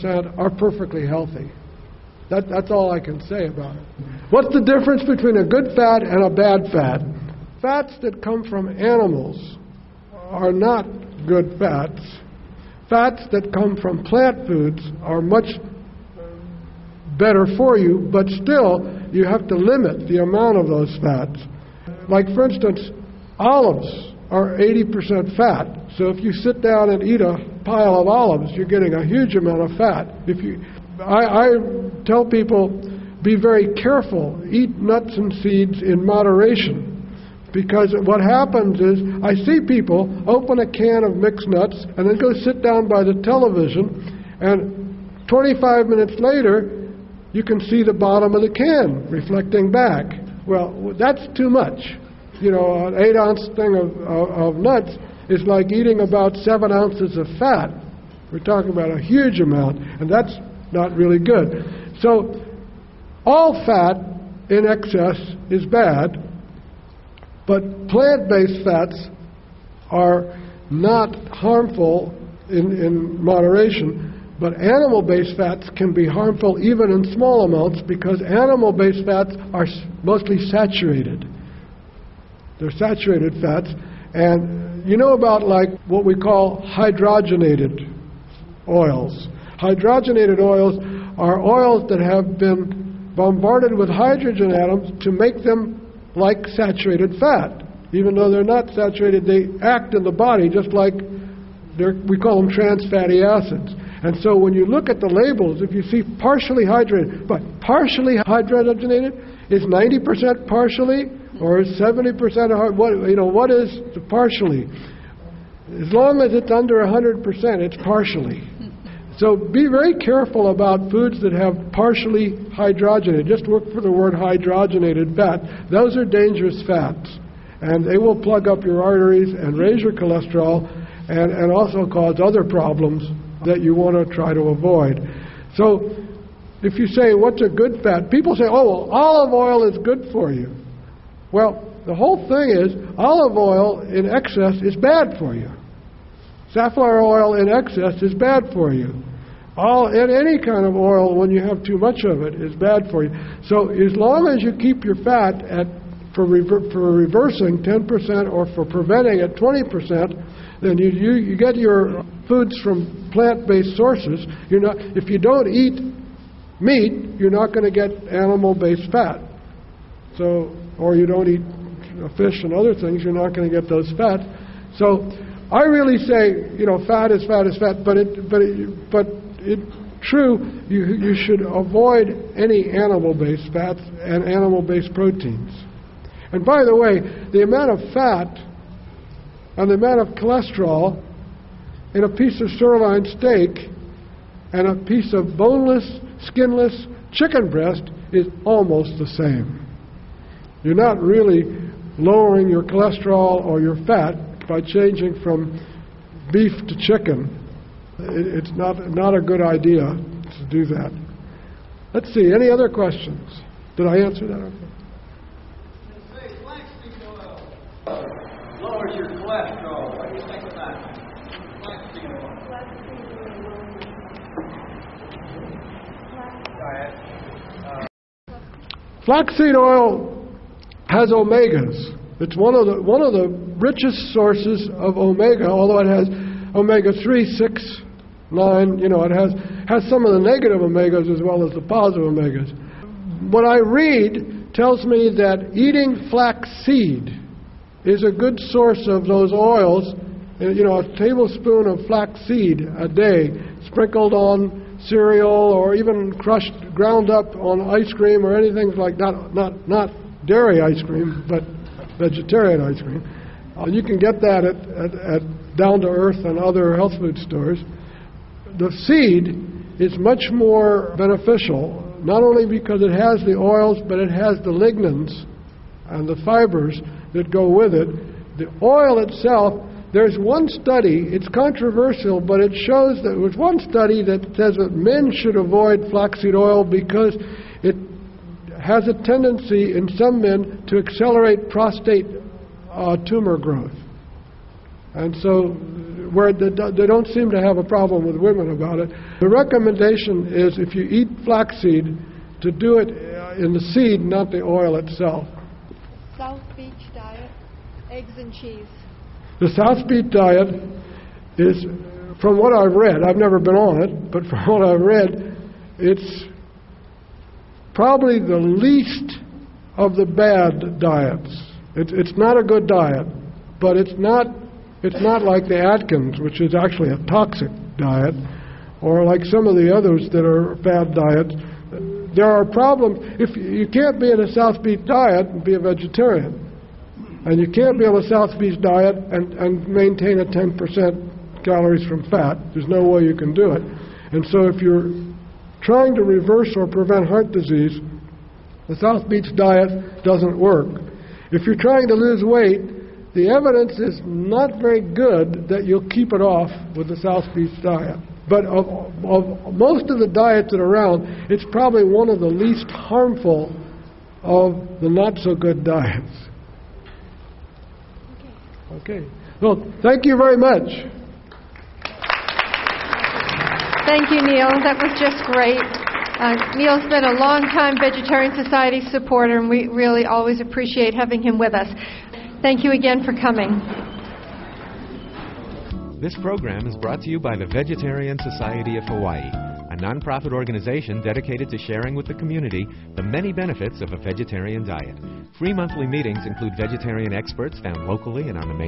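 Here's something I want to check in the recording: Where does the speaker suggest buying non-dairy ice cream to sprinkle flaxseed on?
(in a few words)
Down to Earth.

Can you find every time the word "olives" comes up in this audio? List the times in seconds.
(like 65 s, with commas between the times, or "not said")
23 s, 28 s, 138 s, 142 s.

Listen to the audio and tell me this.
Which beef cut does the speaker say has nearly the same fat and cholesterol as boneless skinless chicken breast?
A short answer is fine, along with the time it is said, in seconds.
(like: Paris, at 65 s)
Sirloin steak, at 192 s.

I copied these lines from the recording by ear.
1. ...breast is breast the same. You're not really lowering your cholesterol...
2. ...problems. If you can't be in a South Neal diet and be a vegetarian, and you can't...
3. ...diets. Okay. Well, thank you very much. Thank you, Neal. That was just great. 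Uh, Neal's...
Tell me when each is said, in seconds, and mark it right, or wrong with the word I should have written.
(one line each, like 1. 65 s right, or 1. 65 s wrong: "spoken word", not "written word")
1. 197 s wrong: "almost", not "breast"
2. 332 s wrong: "Beach", not "Neal"
3. 365 s right.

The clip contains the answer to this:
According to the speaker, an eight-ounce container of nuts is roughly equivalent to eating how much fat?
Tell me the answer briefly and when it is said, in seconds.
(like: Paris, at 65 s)
7 ounces, at 56 s.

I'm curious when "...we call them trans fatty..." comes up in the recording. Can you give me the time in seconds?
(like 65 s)
102 s.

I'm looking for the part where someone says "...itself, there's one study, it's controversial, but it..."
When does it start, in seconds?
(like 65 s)
278 s.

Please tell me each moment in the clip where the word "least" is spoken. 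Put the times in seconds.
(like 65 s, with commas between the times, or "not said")
318 s, 362 s.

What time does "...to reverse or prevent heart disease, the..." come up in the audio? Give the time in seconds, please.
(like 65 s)
345 s.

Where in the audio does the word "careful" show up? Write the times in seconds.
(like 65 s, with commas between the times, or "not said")
33 s, 119 s.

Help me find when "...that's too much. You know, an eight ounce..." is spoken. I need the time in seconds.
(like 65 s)
50 s.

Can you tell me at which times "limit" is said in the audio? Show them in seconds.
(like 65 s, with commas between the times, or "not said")
19 s.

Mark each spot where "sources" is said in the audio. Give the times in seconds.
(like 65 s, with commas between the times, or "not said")
163 s, 234 s, 248 s.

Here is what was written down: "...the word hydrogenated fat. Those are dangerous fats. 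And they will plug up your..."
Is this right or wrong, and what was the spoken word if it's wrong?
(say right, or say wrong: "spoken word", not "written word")
right.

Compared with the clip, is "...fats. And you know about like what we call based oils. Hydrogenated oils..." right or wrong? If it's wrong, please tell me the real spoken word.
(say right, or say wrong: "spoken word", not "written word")
wrong: "hydrogenated", not "based".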